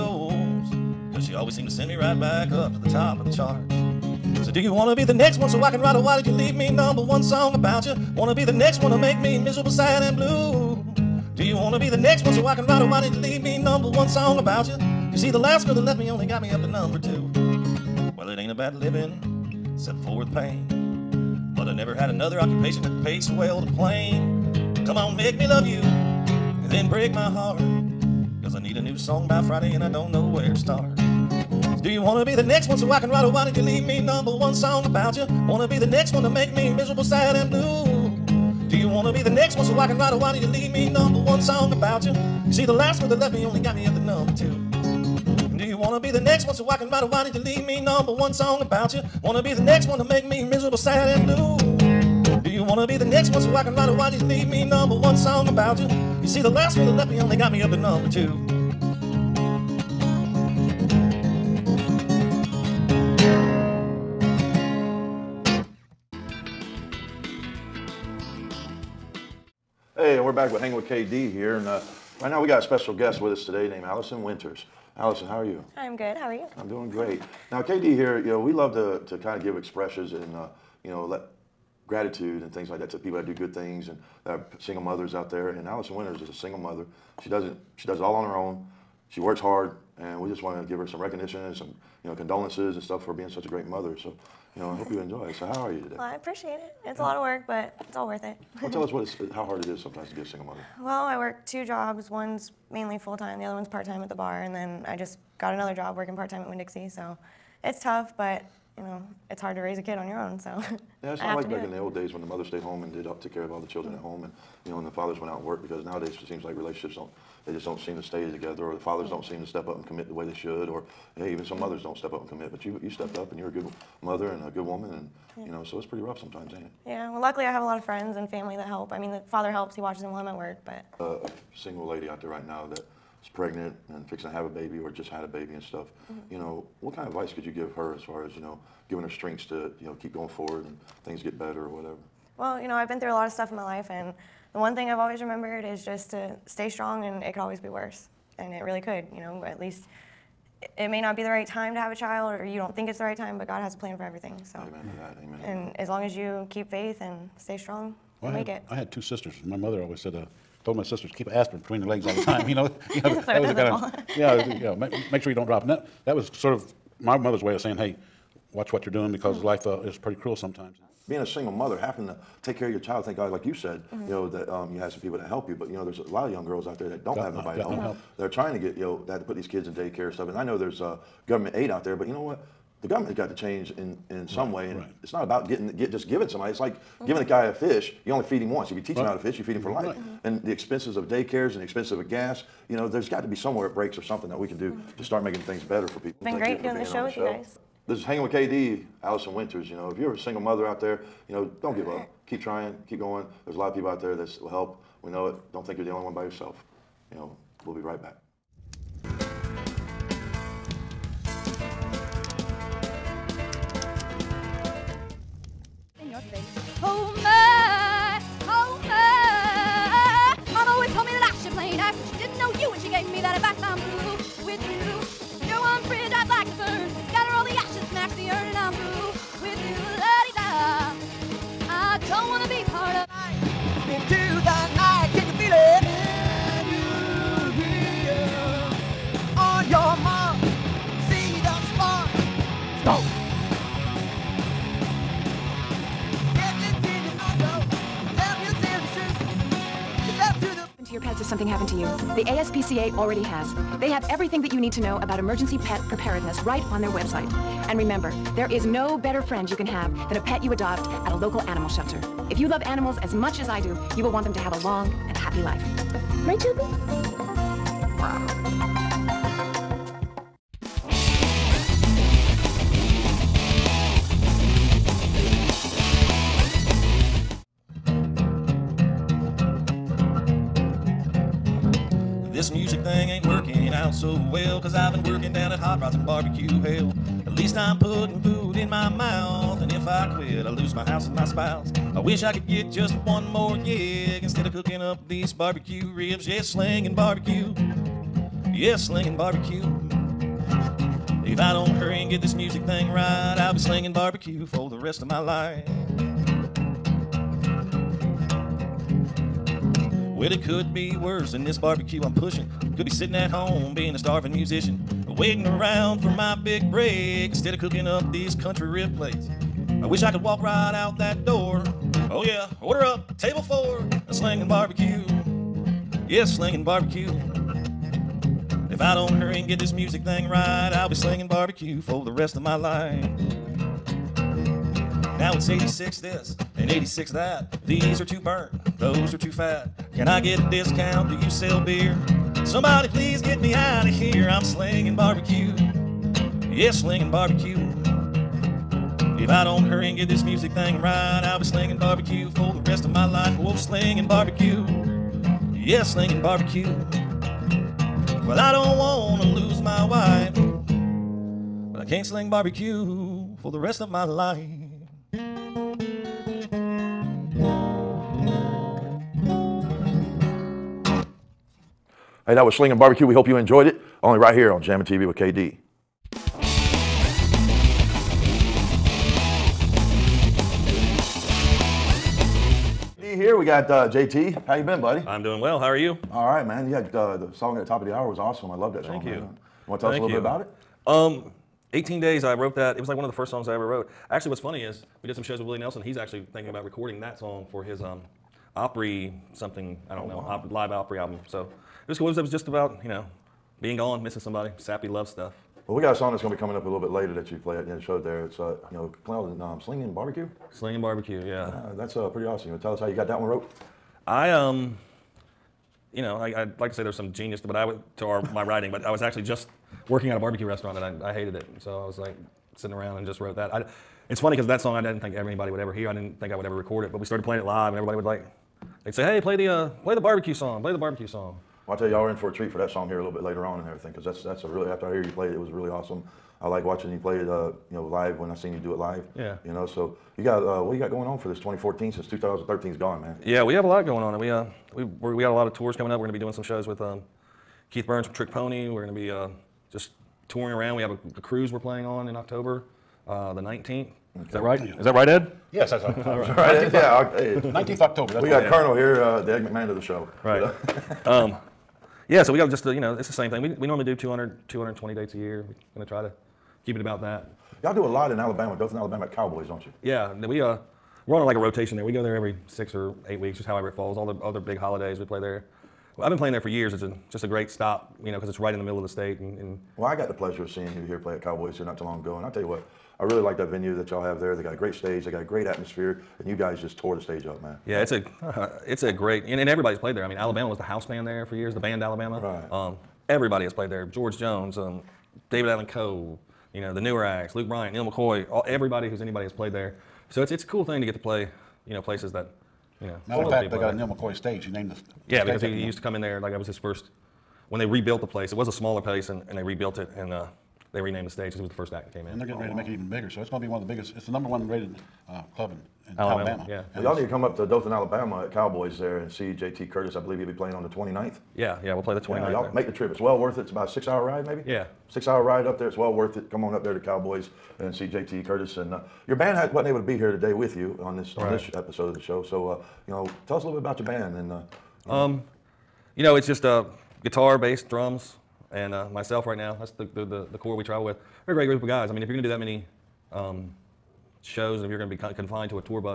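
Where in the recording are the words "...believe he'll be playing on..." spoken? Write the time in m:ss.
8:39.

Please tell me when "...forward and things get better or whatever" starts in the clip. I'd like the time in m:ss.
2:20.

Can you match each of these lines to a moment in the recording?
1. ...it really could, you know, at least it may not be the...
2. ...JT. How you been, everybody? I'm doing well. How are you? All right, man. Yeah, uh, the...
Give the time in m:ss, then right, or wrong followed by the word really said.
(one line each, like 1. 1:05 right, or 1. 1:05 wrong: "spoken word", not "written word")
1. 2:28 right
2. 6:23 wrong: "buddy", not "everybody".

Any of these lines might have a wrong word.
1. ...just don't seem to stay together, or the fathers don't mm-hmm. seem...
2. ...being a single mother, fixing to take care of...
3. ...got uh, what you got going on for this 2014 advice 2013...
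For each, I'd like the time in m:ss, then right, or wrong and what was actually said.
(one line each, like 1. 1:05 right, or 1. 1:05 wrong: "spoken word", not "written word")
1. 1:57 right
2. 2:51 wrong: "having", not "fixing"
3. 7:20 wrong: "since", not "advice".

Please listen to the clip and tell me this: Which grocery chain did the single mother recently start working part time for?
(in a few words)
Winn Dixie.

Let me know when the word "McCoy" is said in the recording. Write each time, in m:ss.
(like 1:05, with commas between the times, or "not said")
8:17, 8:23.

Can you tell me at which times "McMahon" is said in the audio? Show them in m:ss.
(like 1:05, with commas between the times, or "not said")
7:39.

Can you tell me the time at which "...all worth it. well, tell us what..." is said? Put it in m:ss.
1:37.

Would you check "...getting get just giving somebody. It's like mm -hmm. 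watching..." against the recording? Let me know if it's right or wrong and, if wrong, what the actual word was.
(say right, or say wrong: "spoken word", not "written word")
wrong: "giving", not "watching".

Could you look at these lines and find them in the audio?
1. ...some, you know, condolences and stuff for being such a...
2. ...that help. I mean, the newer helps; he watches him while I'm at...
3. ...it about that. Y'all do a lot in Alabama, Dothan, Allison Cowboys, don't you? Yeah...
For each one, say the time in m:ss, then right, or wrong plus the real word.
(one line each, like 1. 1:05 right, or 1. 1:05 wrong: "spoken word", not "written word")
1. 1:31 right
2. 2:08 wrong: "father", not "newer"
3. 7:46 wrong: "Alabama", not "Allison".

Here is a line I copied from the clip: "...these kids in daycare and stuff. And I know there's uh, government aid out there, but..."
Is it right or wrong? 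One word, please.
right.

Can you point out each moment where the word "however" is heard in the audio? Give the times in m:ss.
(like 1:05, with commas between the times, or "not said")
7:53.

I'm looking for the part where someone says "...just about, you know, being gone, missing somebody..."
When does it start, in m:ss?
6:42.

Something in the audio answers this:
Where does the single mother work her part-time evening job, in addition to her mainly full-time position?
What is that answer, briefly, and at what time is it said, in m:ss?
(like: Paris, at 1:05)
the bar, at 1:44.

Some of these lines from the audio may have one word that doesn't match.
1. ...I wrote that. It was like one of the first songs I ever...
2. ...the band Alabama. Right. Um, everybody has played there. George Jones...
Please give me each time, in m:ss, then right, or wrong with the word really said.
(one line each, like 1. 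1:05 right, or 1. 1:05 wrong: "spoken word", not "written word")
1. 6:32 right
2. 8:11 right.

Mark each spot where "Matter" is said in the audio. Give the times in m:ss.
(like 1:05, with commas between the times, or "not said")
8:23.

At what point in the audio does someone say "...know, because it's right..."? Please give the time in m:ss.
7:58.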